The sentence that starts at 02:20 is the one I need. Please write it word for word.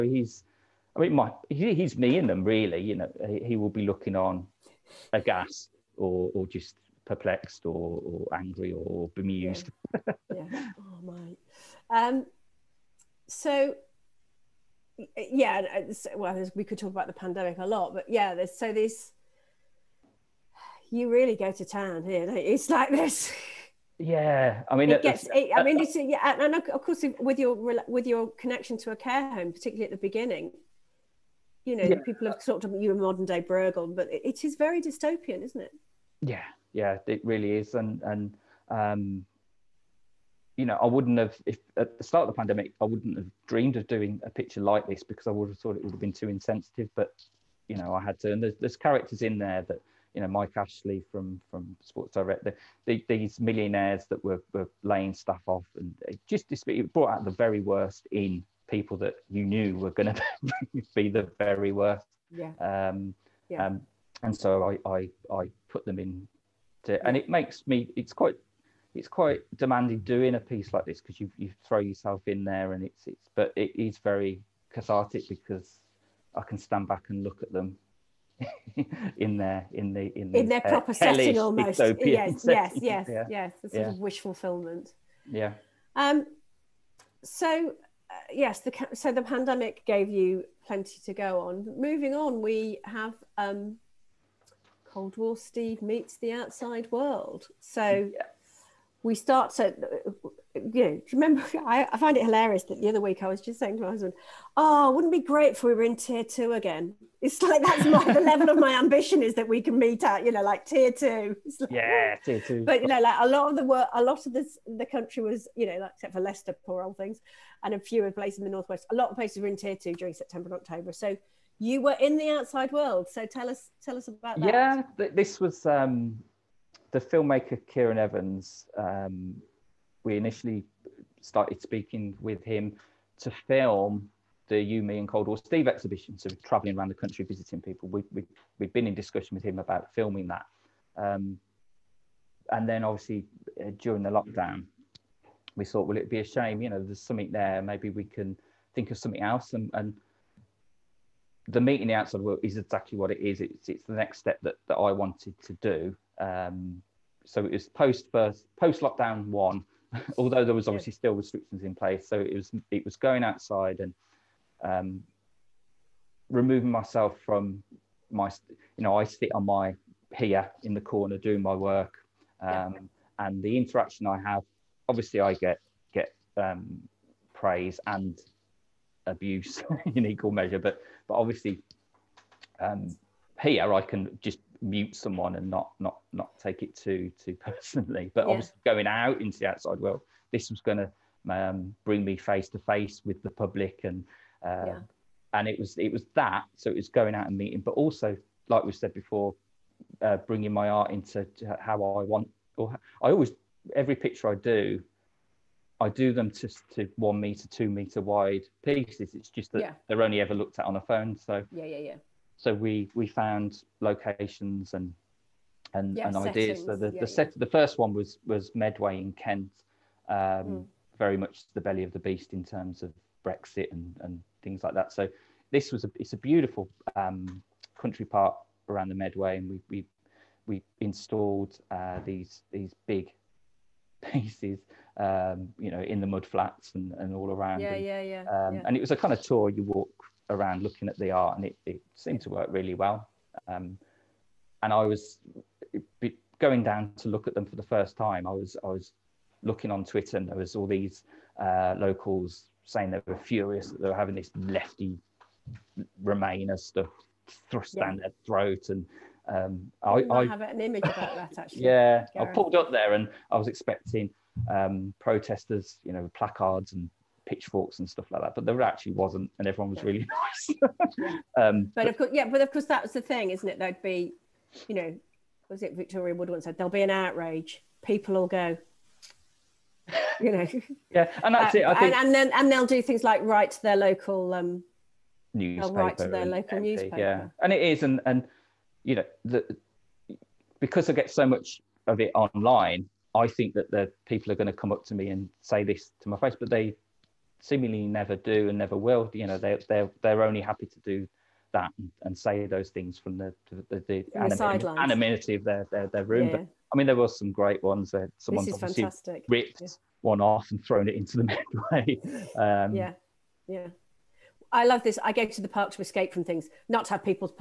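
Um, and then obviously uh, during the lockdown, we thought, well, it'd be a shame, you know, there's something there.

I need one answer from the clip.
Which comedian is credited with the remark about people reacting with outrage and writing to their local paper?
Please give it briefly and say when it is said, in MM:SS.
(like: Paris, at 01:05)
Victoria Wood, at 04:35.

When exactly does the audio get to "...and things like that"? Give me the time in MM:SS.
03:43.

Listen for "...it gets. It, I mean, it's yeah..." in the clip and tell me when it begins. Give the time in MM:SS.
00:24.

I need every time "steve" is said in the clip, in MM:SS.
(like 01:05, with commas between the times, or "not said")
01:35, 02:15.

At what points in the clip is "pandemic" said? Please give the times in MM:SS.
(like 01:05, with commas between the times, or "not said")
00:17, 00:42, 01:29.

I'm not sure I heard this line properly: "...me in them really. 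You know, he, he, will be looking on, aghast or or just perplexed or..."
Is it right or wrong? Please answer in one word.
right.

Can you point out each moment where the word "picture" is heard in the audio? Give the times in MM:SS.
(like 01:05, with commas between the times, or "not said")
00:44, 03:23.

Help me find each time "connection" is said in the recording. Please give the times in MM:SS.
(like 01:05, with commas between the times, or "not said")
00:28.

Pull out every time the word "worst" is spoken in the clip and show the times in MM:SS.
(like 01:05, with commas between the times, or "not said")
00:57, 01:01.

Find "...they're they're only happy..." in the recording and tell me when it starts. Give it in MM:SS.
04:59.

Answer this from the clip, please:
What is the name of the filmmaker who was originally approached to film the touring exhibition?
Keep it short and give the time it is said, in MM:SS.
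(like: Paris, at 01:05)
Kieran Evans, at 02:07.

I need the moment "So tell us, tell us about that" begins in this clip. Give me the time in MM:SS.
02:03.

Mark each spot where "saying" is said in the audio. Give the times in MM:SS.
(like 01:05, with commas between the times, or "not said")
01:43, 04:12.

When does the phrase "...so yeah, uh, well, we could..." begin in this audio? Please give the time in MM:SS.
00:13.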